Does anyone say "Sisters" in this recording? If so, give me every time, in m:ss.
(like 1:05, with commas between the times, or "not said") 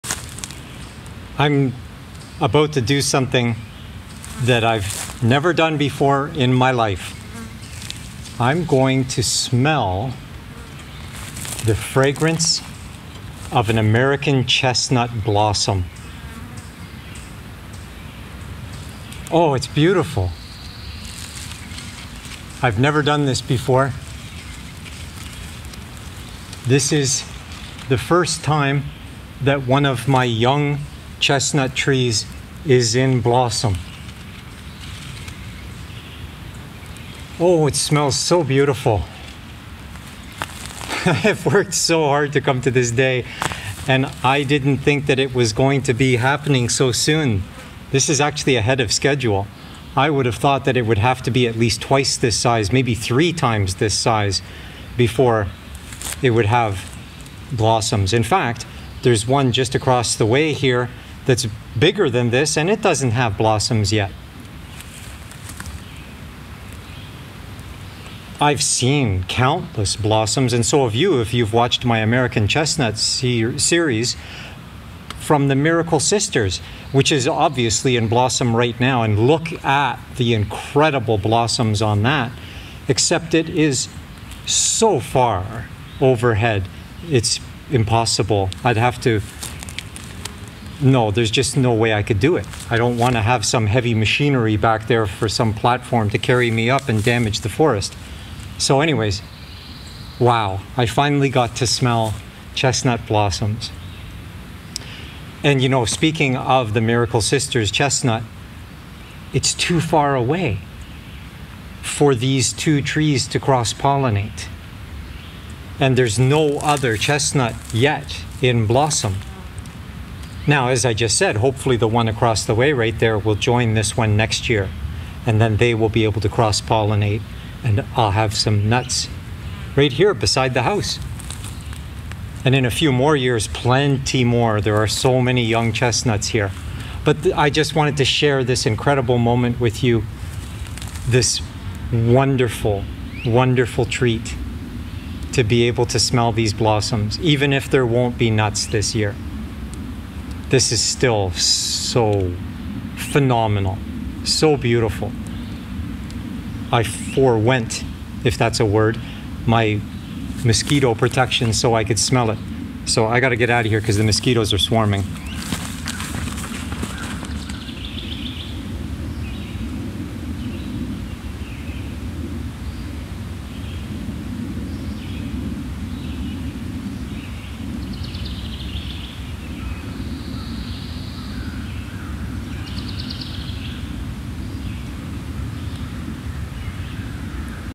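1:15, 1:47.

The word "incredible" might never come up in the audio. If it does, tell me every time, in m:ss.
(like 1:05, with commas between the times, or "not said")
1:20, 2:18.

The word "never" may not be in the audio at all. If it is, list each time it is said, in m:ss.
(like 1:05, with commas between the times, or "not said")
0:05, 0:22.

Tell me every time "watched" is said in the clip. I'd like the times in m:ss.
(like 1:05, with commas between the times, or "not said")
1:11.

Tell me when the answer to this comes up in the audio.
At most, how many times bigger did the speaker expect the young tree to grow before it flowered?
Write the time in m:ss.
0:52.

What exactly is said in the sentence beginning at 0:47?
This is actually ahead of schedule.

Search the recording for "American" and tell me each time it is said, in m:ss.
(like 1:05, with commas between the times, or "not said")
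0:13, 1:11.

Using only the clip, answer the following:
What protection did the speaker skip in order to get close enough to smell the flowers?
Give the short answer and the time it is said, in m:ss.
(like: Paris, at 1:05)
Mosquito protection, at 2:40.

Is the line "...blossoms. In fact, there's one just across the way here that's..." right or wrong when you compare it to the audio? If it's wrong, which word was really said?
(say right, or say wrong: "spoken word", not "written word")
right.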